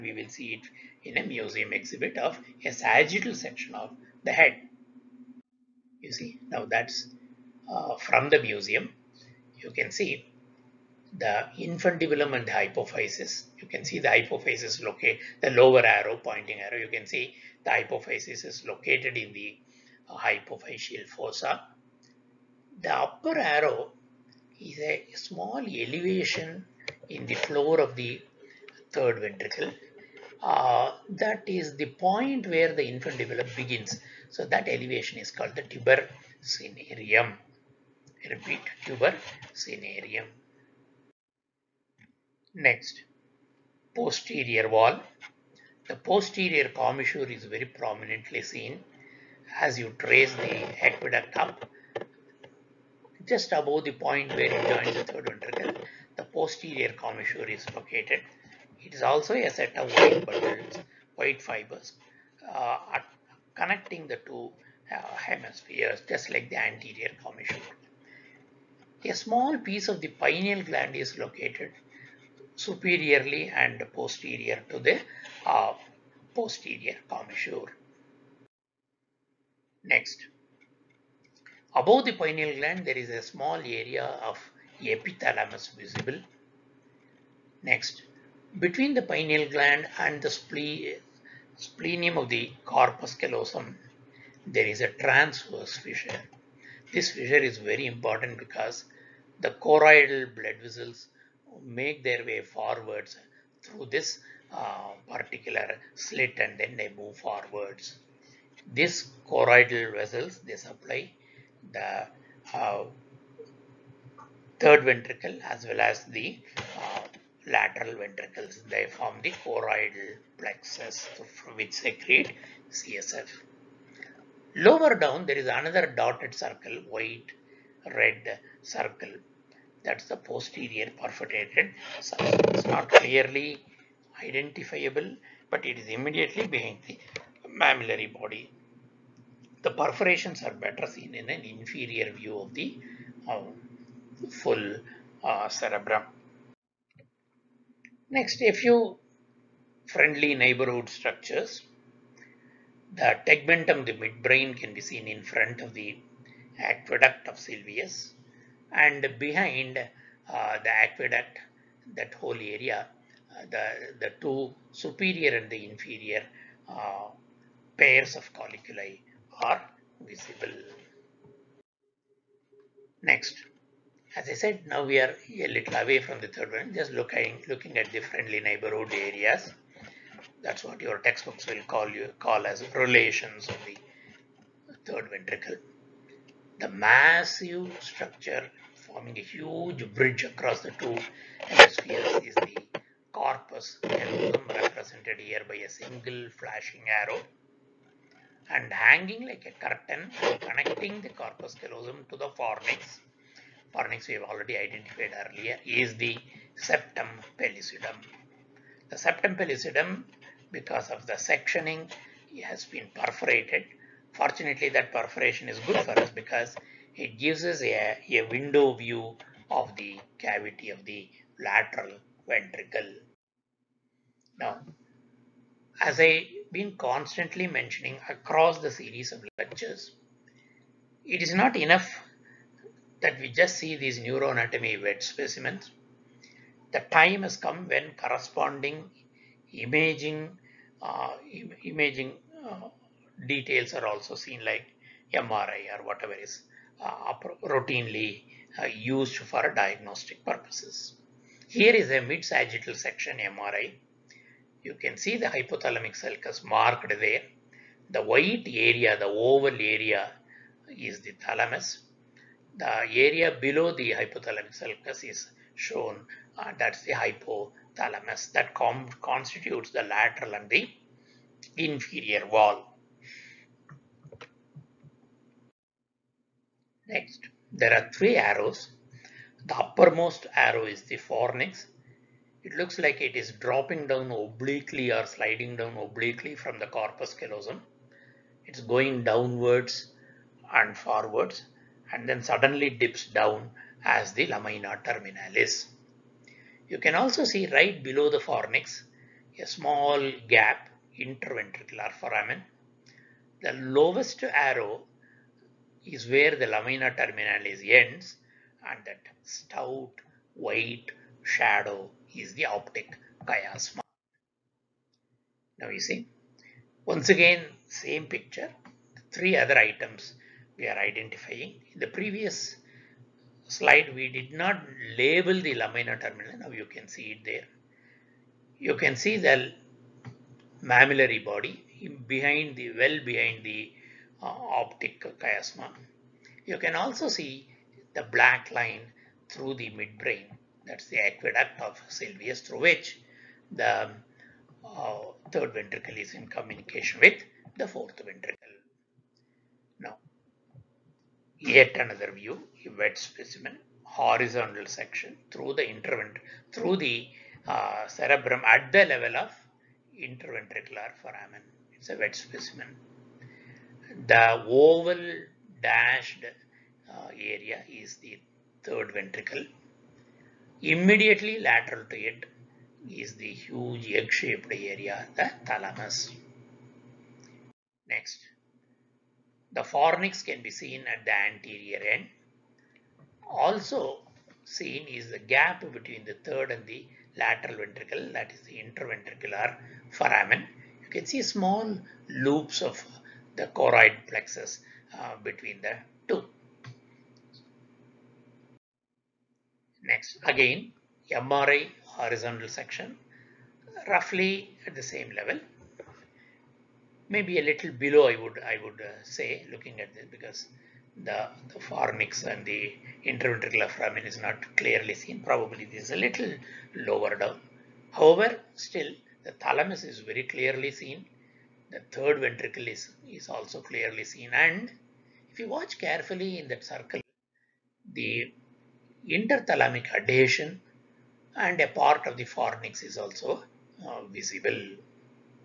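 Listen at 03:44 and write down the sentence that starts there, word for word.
Now as I been constantly mentioning across the series of lectures.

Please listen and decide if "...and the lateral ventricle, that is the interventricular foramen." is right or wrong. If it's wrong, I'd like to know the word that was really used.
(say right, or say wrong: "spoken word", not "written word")
right.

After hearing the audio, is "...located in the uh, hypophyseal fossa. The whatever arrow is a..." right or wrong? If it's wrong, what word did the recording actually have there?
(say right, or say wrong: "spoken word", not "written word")
wrong: "upper", not "whatever".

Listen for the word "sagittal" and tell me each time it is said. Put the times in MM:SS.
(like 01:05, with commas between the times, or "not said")
00:02, 04:11.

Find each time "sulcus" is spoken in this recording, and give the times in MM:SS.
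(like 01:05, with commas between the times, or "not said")
04:16, 04:24.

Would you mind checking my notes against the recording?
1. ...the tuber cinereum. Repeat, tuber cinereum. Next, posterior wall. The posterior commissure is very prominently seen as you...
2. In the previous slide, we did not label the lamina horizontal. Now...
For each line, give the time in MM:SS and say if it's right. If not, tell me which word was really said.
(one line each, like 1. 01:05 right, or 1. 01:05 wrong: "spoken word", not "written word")
1. 00:35 right
2. 05:21 wrong: "terminal", not "horizontal".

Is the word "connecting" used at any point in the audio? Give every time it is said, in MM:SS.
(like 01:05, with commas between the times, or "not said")
01:03, 03:20.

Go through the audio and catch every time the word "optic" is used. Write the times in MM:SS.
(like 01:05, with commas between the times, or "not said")
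05:12, 05:34.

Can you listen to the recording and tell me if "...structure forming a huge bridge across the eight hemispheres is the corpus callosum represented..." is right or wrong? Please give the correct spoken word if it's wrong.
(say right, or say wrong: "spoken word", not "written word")
wrong: "two", not "eight".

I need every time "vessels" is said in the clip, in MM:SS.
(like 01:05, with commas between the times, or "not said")
01:40, 01:49.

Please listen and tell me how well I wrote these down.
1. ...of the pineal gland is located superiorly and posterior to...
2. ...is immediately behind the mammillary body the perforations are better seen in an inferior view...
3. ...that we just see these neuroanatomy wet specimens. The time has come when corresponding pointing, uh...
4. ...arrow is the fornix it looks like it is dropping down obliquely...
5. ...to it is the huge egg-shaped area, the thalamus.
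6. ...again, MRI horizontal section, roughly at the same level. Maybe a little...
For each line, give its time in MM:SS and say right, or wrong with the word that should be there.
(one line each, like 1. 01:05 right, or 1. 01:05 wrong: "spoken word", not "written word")
1. 01:09 right
2. 02:15 right
3. 03:53 wrong: "imaging", not "pointing"
4. 04:40 right
5. 06:11 right
6. 06:40 right.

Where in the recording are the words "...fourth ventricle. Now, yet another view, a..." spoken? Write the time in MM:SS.
05:47.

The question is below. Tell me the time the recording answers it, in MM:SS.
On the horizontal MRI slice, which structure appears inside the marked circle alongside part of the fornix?
07:09.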